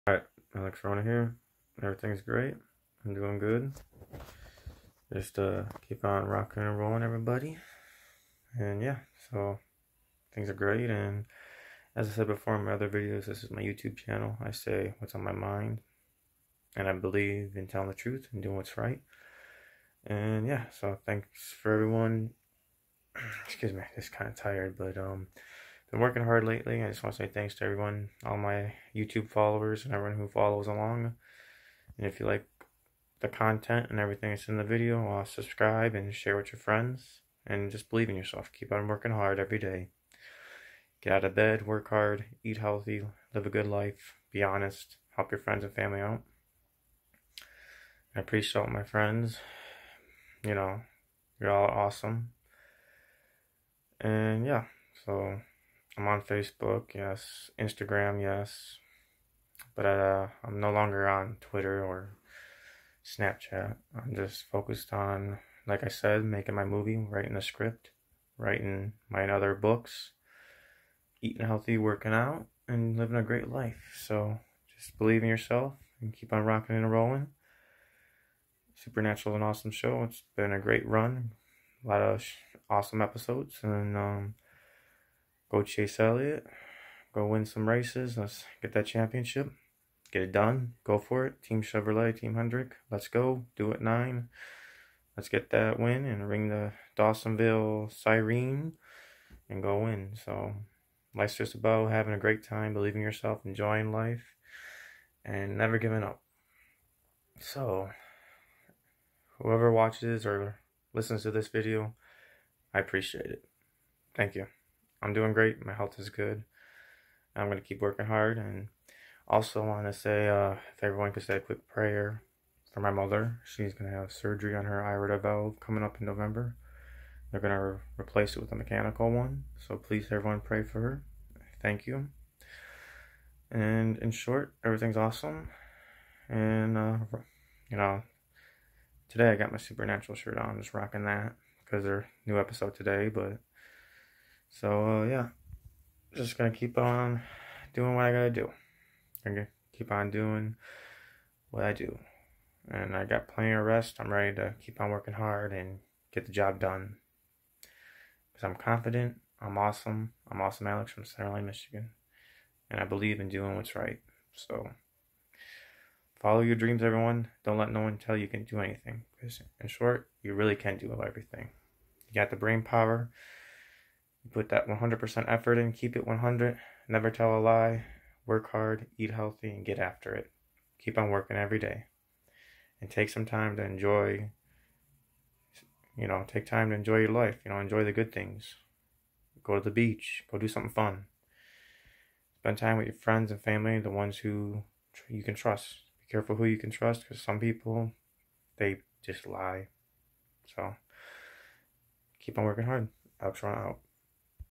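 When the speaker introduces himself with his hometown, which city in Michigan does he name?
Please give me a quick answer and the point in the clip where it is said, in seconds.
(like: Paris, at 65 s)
Center Line, at 161 s.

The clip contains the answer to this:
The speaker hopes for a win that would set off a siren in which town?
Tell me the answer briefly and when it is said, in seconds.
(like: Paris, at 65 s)
Dawsonville, at 96 s.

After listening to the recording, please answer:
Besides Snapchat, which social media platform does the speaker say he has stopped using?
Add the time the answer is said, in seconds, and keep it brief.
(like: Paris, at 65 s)
Twitter, at 61 s.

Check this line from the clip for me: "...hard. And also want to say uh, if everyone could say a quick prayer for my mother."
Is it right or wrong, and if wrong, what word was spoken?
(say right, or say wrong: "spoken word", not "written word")
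right.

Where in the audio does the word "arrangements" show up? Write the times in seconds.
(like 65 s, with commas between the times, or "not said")
not said.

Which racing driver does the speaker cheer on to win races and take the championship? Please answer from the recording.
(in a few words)
Chase Elliott.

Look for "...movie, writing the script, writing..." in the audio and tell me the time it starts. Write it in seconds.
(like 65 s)
66 s.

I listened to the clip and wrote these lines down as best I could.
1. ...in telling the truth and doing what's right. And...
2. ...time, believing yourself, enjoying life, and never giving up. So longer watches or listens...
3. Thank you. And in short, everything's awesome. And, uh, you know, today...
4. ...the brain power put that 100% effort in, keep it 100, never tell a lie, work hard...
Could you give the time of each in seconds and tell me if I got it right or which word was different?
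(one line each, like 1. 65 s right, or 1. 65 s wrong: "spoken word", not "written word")
1. 17 s right
2. 102 s wrong: "whoever", not "longer"
3. 131 s right
4. 172 s right.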